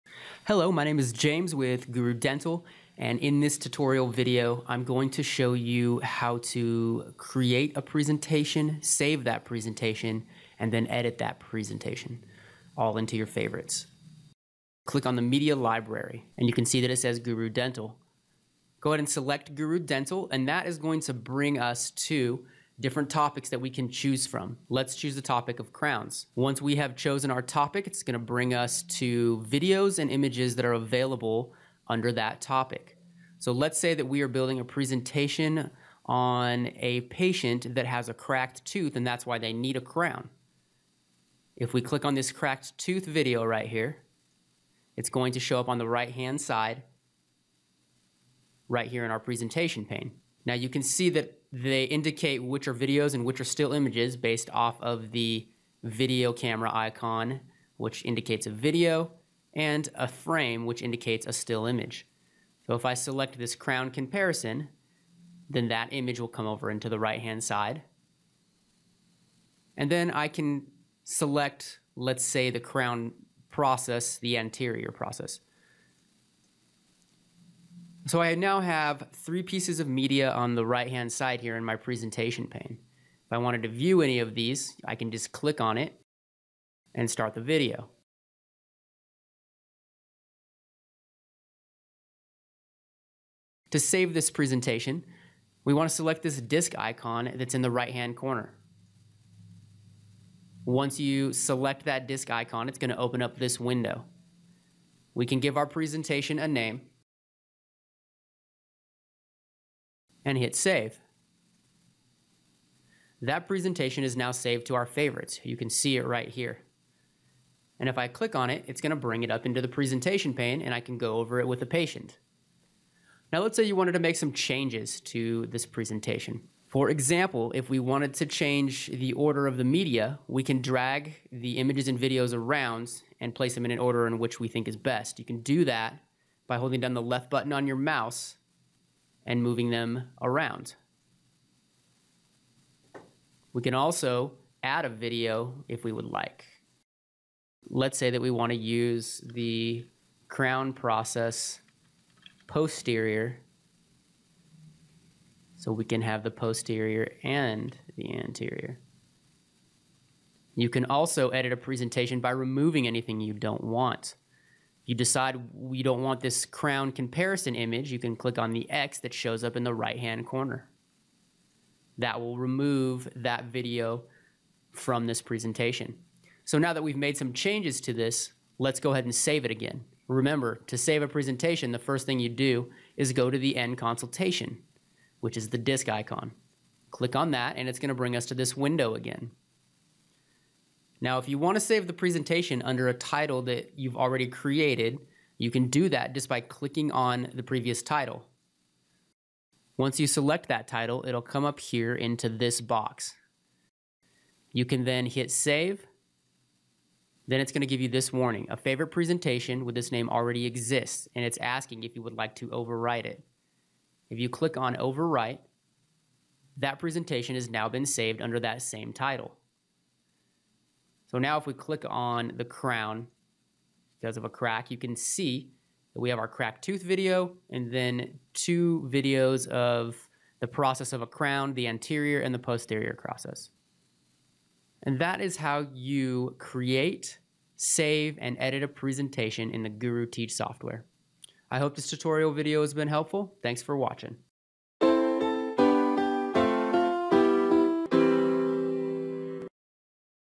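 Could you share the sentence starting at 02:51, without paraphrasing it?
That will remove that video from this presentation.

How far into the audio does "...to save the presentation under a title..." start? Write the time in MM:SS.
03:11.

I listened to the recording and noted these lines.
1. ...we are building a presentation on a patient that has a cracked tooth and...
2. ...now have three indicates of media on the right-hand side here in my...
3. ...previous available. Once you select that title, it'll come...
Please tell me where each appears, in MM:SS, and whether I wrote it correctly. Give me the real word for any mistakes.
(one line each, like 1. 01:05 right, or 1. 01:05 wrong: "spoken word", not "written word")
1. 00:34 right
2. 01:18 wrong: "pieces", not "indicates"
3. 03:17 wrong: "title", not "available".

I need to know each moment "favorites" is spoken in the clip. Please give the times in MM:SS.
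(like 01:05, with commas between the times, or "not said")
00:13, 01:54, 03:28.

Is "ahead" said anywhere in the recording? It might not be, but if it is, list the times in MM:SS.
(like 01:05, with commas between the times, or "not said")
00:18, 02:58.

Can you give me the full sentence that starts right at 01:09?
And then I can select, let's say, the crown process, the anterior process.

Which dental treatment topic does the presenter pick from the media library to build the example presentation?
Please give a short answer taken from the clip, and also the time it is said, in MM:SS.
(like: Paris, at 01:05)
Crowns, at 00:25.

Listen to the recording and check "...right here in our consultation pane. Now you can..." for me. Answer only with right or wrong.
wrong.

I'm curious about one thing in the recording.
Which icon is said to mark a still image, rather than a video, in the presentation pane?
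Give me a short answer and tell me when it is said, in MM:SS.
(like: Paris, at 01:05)
A frame, at 00:59.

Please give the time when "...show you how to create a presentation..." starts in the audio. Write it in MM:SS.
00:05.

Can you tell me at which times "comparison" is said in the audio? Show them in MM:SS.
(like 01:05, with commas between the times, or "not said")
01:03, 02:46.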